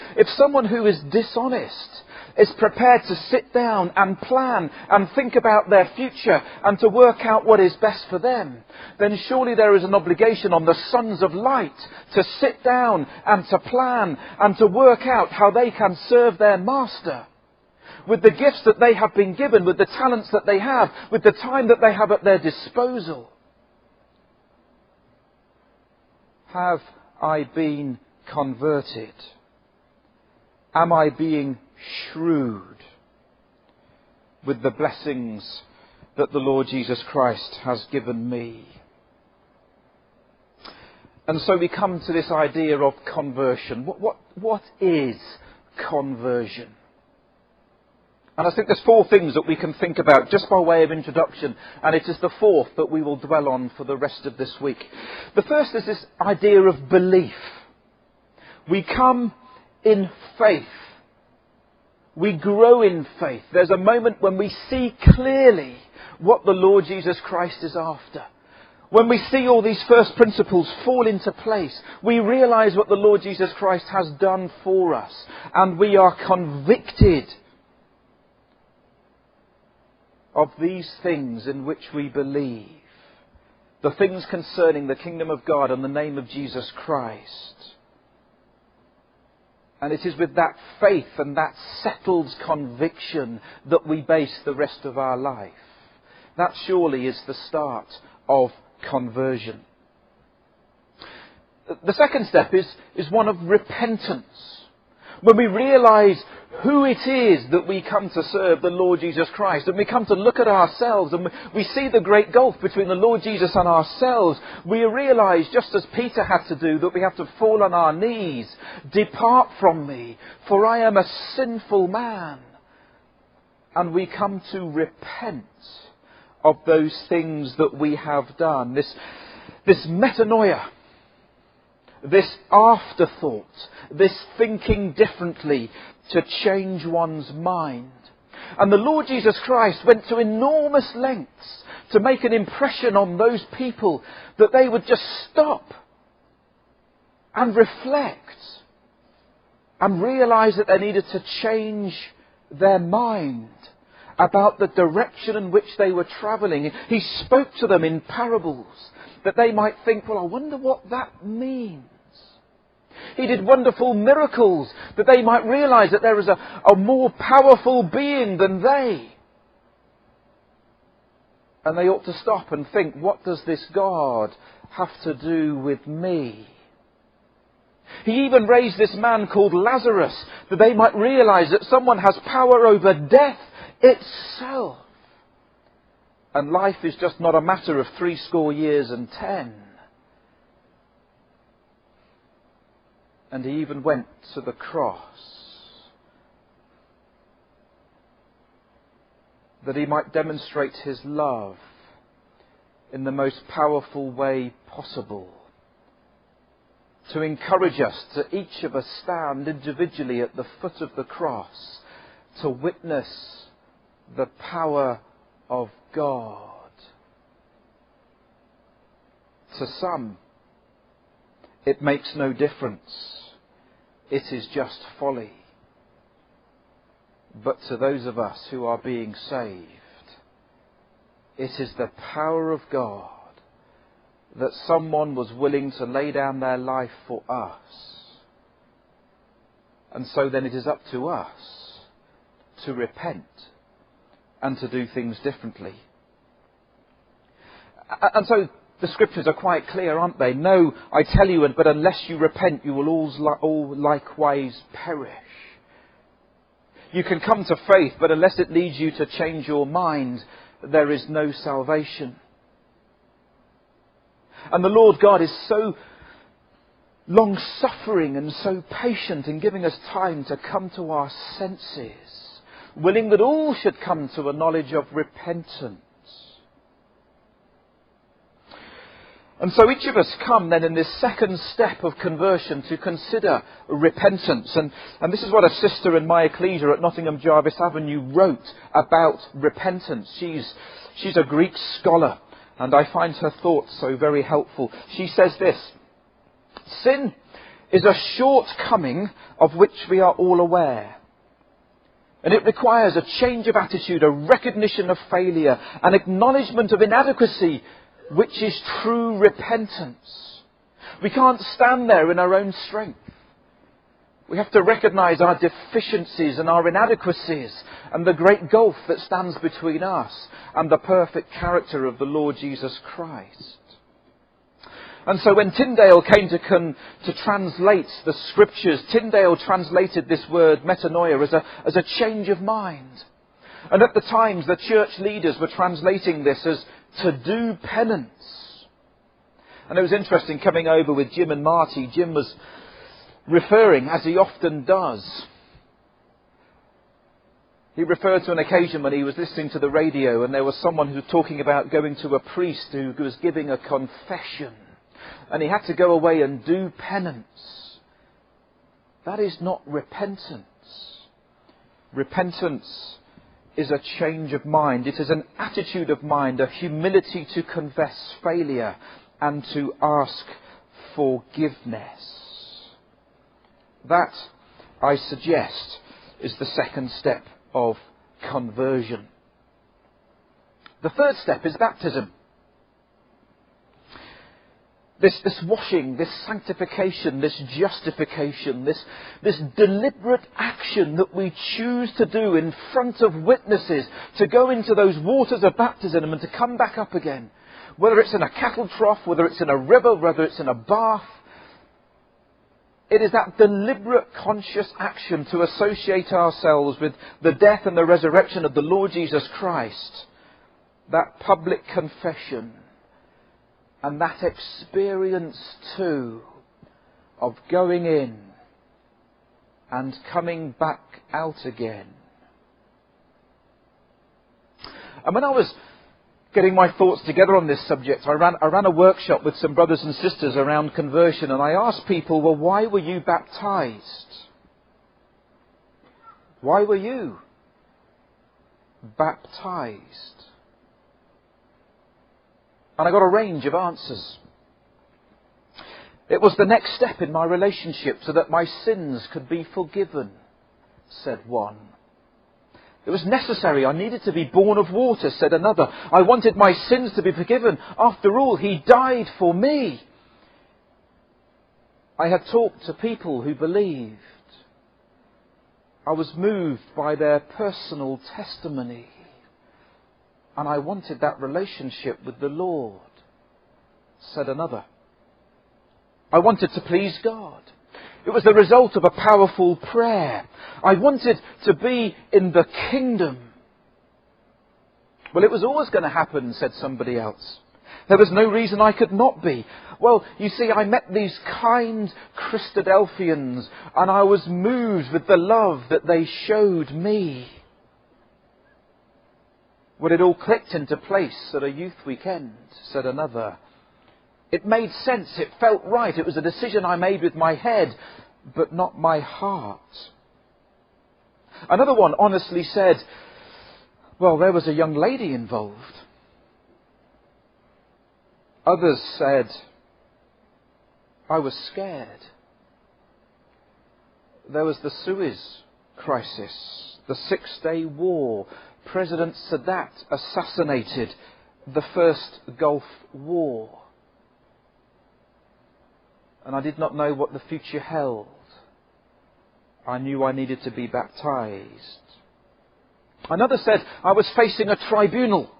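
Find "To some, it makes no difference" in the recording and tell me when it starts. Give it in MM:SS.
03:39.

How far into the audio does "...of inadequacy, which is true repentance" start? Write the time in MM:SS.
05:06.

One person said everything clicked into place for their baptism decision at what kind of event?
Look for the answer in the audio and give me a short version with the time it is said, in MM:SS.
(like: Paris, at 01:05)
youth weekend, at 08:21.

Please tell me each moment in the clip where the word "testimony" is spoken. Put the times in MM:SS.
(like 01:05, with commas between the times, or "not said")
07:48.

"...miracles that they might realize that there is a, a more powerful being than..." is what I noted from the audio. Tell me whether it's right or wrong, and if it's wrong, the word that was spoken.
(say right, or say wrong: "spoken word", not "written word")
right.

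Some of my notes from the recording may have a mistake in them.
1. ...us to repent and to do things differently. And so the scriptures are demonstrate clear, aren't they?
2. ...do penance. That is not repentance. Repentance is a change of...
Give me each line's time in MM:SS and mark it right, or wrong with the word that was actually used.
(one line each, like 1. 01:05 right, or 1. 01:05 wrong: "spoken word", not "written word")
1. 04:01 wrong: "quite", not "demonstrate"
2. 05:56 right.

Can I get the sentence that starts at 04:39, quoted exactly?
And so each of us come then in this second step of conversion to consider repentance.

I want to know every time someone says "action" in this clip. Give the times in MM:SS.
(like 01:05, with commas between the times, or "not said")
06:30, 06:44.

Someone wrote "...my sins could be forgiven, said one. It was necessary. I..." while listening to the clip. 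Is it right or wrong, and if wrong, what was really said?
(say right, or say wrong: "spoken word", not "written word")
right.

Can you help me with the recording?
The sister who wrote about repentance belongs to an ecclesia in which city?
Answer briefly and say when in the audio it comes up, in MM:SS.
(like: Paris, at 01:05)
Nottingham, at 04:46.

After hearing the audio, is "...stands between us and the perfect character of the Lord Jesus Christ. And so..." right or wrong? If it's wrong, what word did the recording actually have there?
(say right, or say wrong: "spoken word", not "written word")
right.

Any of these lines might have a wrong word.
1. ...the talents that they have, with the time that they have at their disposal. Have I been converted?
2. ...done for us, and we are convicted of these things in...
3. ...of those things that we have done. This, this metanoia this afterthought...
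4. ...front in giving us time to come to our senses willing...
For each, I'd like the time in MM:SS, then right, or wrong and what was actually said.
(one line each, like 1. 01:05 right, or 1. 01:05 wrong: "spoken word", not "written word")
1. 00:19 right
2. 01:14 right
3. 02:06 right
4. 04:28 wrong: "patient", not "front".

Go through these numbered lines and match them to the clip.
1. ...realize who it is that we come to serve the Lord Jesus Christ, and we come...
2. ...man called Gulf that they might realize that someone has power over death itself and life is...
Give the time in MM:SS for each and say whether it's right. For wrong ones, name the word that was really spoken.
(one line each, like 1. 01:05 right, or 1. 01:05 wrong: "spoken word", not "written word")
1. 01:45 right
2. 02:58 wrong: "Lazarus", not "Gulf".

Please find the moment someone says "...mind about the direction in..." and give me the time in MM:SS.
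02:32.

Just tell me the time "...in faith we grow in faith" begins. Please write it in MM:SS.
00:59.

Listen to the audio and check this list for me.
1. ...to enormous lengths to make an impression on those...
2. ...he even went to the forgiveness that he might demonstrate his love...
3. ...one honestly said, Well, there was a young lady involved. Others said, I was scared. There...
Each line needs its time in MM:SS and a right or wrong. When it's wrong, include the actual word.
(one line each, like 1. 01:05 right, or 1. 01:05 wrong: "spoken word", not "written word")
1. 02:20 right
2. 03:13 wrong: "cross", not "forgiveness"
3. 08:31 right.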